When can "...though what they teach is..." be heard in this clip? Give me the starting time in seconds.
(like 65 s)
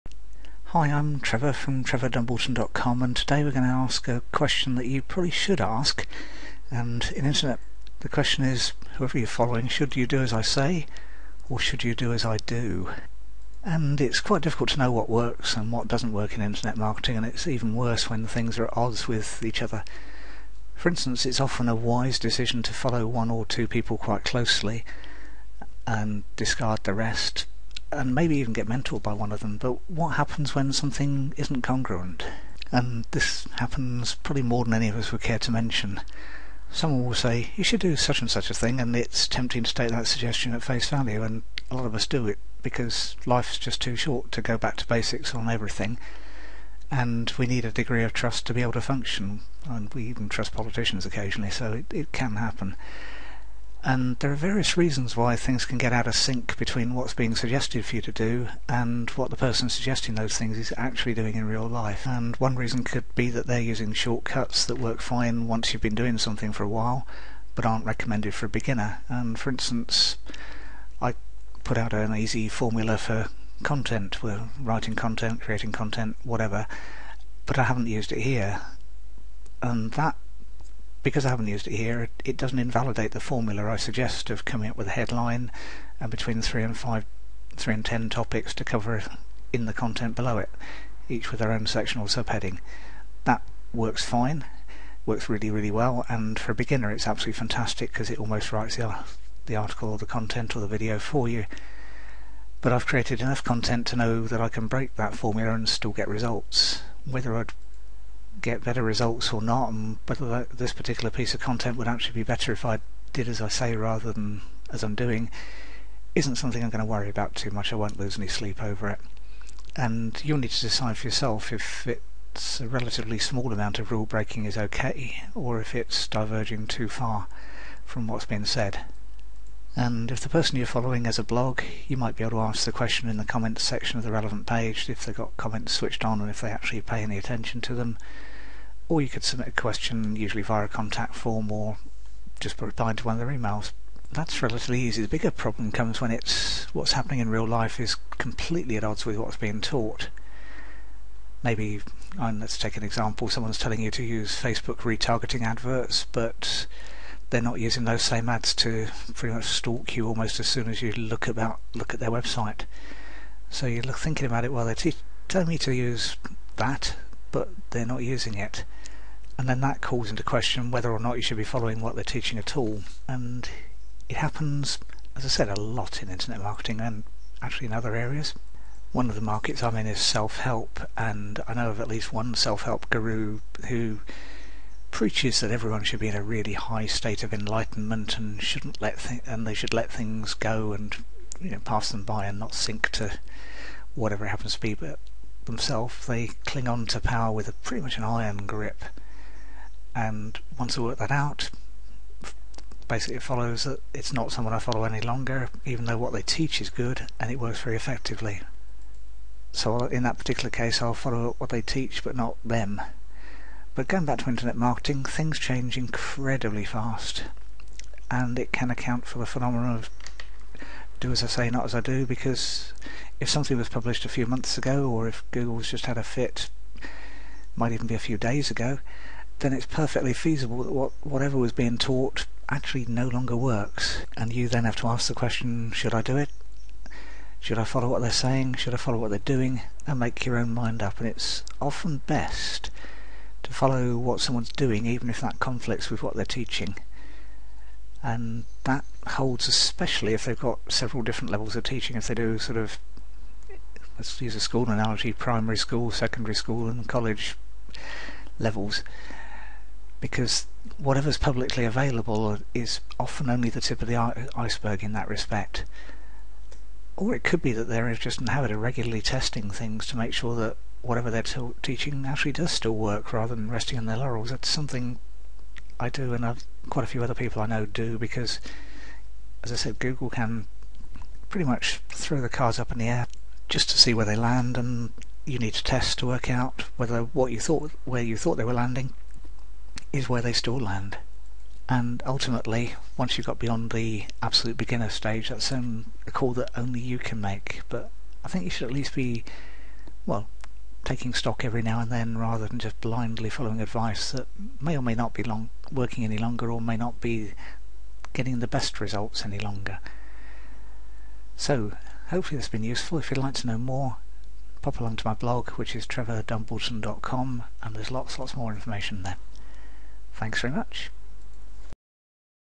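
205 s.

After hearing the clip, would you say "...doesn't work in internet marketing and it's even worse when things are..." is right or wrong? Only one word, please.
right.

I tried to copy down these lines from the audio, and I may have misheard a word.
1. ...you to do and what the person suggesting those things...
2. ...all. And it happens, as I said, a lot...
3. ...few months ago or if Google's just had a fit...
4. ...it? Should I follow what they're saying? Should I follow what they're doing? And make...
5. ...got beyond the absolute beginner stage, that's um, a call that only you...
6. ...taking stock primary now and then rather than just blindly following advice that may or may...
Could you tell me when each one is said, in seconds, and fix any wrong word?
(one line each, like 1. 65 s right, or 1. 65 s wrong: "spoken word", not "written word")
1. 57 s right
2. 172 s right
3. 224 s right
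4. 236 s right
5. 293 s right
6. 300 s wrong: "every", not "primary".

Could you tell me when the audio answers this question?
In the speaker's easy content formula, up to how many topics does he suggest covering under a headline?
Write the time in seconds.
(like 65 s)
87 s.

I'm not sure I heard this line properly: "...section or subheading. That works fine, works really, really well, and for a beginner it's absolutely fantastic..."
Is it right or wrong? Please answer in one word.
right.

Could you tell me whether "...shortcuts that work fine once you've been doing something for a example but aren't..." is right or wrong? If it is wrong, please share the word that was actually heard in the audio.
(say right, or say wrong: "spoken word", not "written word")
wrong: "while", not "example".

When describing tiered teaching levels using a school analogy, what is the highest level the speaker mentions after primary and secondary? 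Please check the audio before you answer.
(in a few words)
College.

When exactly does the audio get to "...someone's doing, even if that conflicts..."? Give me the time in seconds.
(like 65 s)
244 s.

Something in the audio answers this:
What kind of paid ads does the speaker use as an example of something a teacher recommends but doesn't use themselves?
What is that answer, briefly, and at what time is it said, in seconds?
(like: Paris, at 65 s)
Facebook retargeting adverts, at 154 s.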